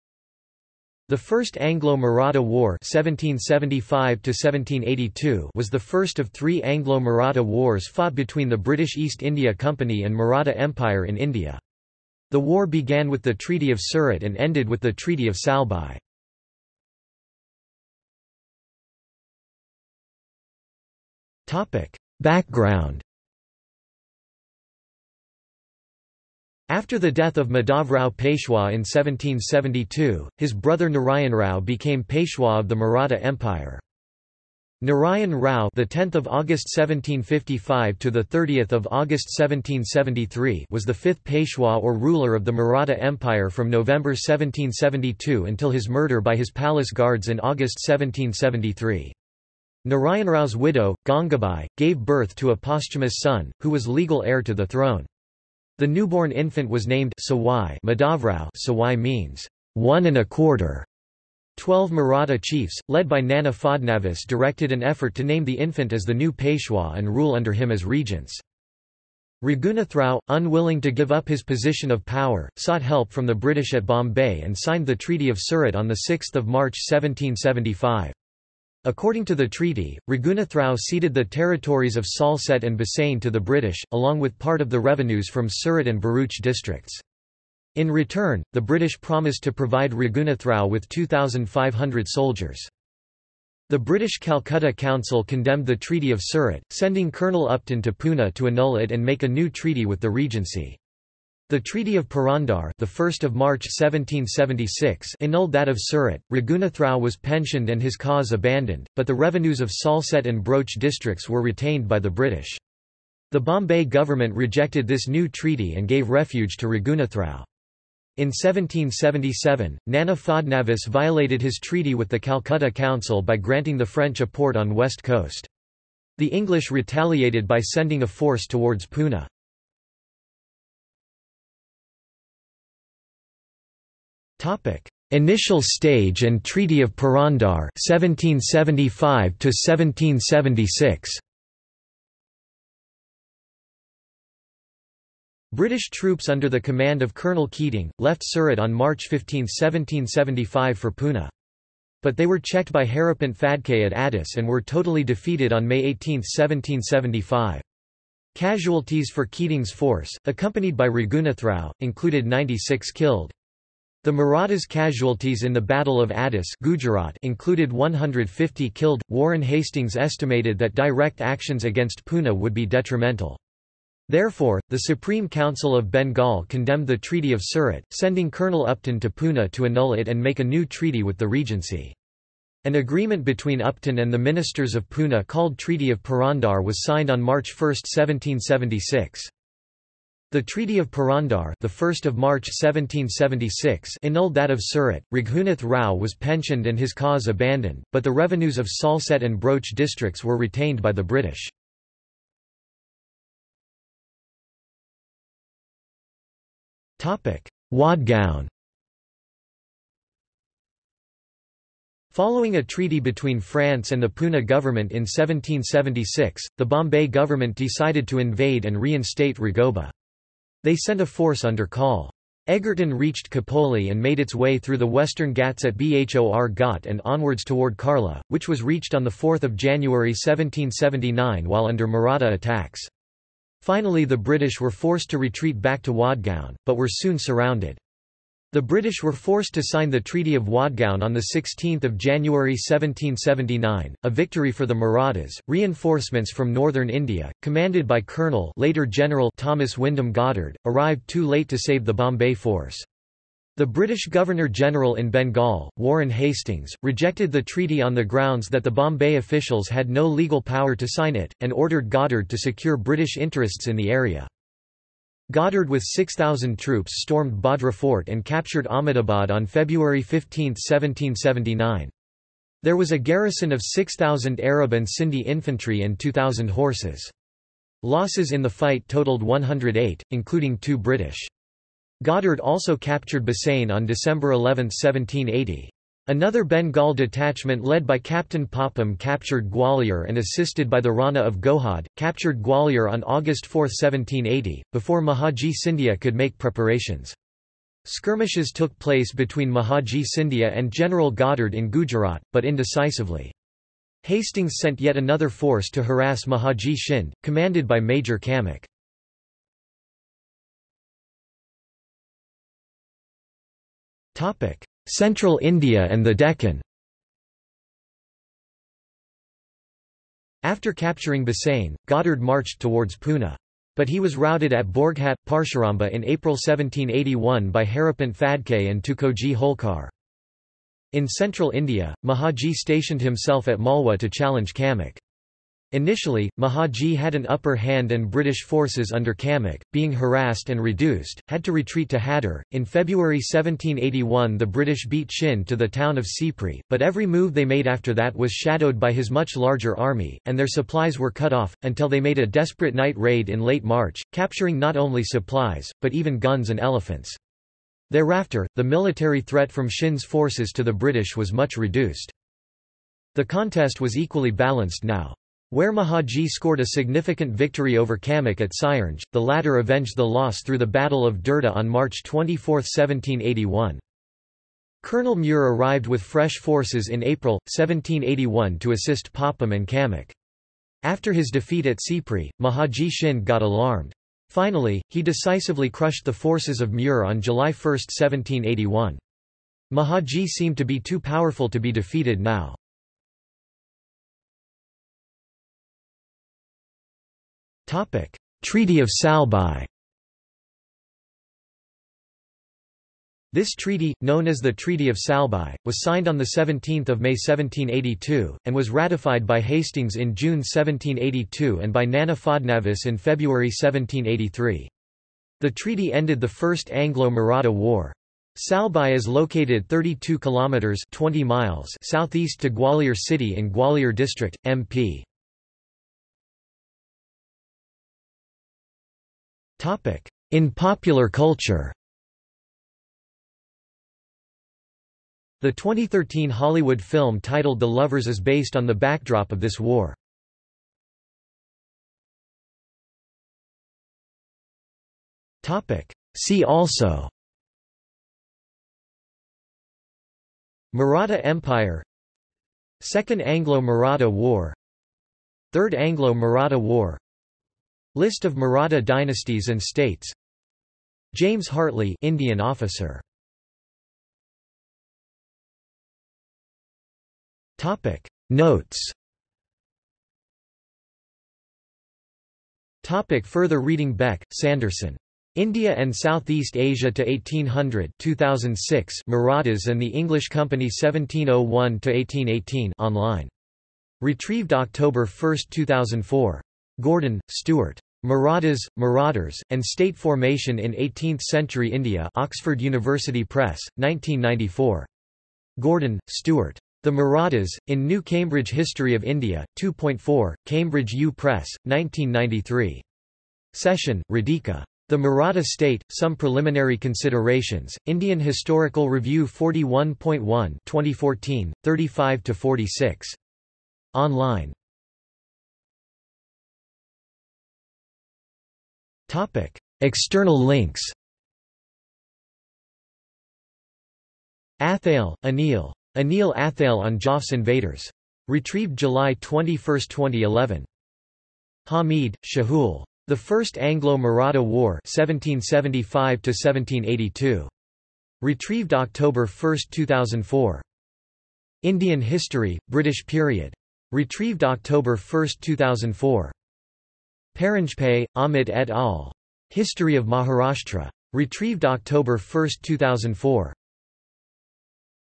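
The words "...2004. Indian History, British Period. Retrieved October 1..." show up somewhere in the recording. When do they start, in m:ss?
8:59.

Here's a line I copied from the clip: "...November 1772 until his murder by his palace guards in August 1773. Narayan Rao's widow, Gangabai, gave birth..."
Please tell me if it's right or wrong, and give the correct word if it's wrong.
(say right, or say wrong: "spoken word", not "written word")
right.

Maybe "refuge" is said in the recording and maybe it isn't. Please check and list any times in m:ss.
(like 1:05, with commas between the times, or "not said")
1:56.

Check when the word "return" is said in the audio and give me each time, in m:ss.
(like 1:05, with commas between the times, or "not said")
1:27.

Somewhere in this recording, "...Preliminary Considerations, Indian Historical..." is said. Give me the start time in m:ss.
8:26.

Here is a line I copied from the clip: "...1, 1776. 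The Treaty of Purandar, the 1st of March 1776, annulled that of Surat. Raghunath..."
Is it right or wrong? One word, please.
right.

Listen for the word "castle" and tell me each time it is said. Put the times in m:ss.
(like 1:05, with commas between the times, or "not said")
not said.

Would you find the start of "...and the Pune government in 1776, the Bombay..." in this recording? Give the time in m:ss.
3:33.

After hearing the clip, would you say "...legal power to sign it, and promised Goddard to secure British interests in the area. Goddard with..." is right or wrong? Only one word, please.
wrong.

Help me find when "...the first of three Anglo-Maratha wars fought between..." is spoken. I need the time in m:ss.
0:05.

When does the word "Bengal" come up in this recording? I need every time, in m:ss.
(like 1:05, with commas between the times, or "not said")
2:55, 4:15, 4:46.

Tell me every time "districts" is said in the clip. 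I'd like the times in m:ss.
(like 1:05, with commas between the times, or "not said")
1:26, 1:50, 3:19, 7:03.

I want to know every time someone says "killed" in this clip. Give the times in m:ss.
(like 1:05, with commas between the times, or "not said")
2:42, 2:48.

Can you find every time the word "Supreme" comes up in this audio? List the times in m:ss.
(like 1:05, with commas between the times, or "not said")
2:54.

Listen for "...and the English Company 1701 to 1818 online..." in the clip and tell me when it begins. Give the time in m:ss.
7:59.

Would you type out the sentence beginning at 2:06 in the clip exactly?
The English retaliated by sending a force towards Pune.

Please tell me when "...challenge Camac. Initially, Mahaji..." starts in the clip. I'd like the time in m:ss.
5:34.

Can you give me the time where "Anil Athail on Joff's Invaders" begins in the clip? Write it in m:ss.
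8:45.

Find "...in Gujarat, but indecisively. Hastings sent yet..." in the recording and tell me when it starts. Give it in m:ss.
5:01.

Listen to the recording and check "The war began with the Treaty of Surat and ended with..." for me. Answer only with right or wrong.
right.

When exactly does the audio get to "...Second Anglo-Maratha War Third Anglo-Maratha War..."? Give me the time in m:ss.
7:32.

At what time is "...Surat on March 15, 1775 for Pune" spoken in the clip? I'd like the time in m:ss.
2:28.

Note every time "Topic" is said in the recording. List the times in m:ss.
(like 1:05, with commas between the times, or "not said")
0:21, 2:14, 3:26, 7:47, 7:52.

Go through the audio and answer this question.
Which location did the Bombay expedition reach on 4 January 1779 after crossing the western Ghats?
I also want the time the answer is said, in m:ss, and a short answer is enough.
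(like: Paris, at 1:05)
Karla, at 3:47.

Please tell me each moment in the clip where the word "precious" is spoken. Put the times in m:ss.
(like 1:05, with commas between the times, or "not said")
not said.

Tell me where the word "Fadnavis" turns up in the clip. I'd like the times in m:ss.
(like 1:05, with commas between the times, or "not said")
1:03, 2:00, 6:52.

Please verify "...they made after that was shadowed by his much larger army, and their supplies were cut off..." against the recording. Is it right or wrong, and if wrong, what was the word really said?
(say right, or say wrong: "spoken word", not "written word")
right.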